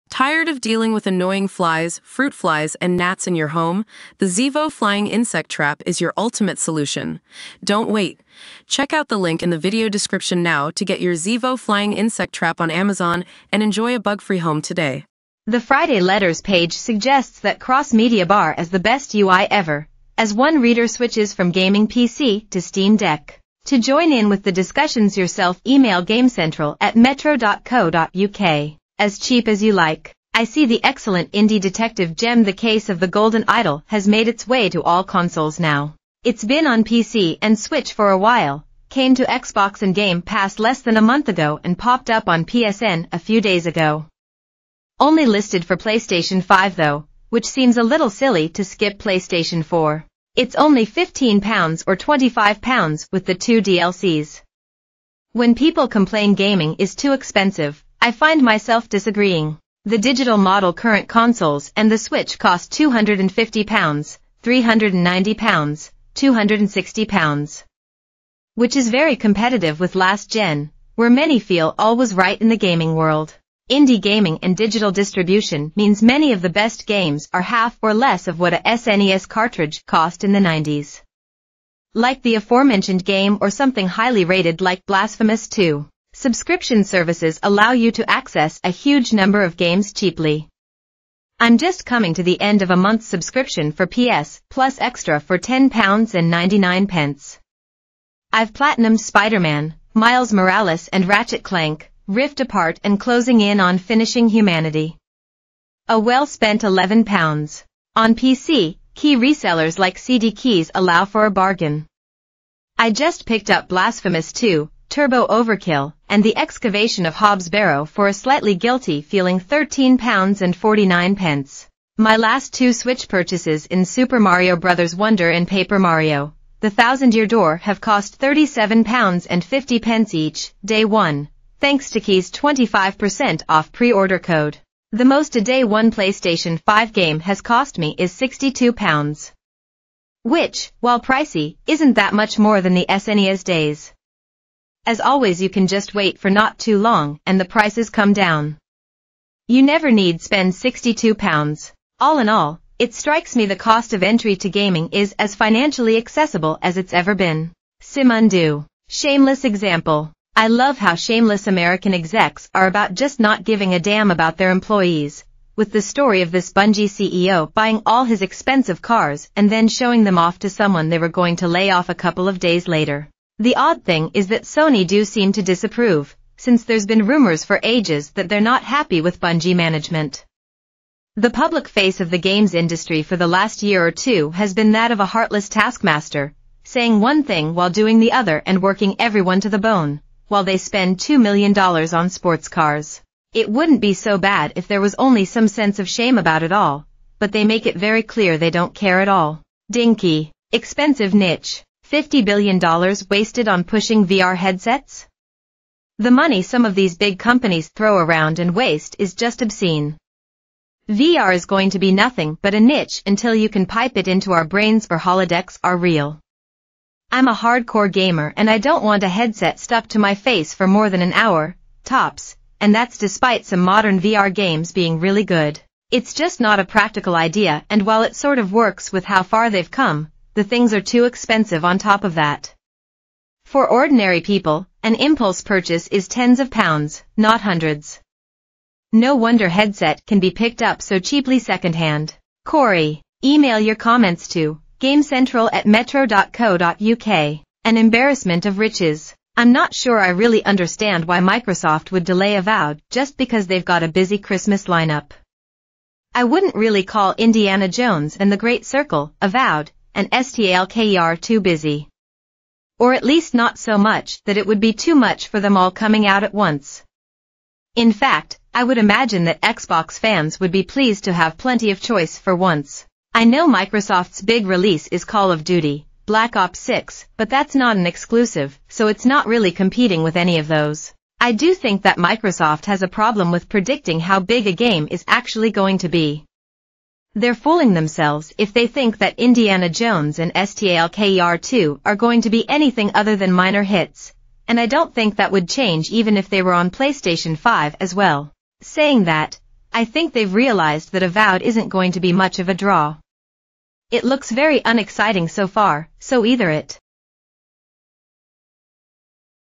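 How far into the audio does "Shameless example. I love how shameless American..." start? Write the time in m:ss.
2:38.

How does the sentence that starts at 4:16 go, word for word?
I wouldn't really call Indiana Jones and the Great Circle Avowed and STALKER too busy.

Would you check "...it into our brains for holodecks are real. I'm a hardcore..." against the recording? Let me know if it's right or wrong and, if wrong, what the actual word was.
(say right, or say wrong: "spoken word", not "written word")
right.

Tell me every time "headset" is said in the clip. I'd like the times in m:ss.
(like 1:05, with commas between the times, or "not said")
3:24, 3:39, 3:59.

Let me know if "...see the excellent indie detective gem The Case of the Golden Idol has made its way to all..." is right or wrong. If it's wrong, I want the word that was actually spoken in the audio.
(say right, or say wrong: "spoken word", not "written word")
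right.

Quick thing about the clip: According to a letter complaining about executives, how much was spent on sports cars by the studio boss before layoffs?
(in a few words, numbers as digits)
$2 million.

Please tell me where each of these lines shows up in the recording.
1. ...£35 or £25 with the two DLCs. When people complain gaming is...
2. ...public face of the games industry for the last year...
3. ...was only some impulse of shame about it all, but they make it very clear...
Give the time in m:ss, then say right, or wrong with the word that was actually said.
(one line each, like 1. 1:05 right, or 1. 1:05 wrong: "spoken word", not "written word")
1. 0:50 wrong: "15", not "35"
2. 3:01 right
3. 3:14 wrong: "sense", not "impulse".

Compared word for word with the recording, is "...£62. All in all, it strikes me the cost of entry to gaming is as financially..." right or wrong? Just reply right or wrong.
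right.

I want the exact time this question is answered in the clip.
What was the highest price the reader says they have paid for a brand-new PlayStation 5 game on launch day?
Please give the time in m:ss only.
2:18.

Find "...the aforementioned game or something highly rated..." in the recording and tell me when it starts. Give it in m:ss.
1:22.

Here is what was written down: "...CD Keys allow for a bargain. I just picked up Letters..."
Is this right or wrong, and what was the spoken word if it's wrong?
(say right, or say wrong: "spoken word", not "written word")
wrong: "Blasphemous", not "Letters".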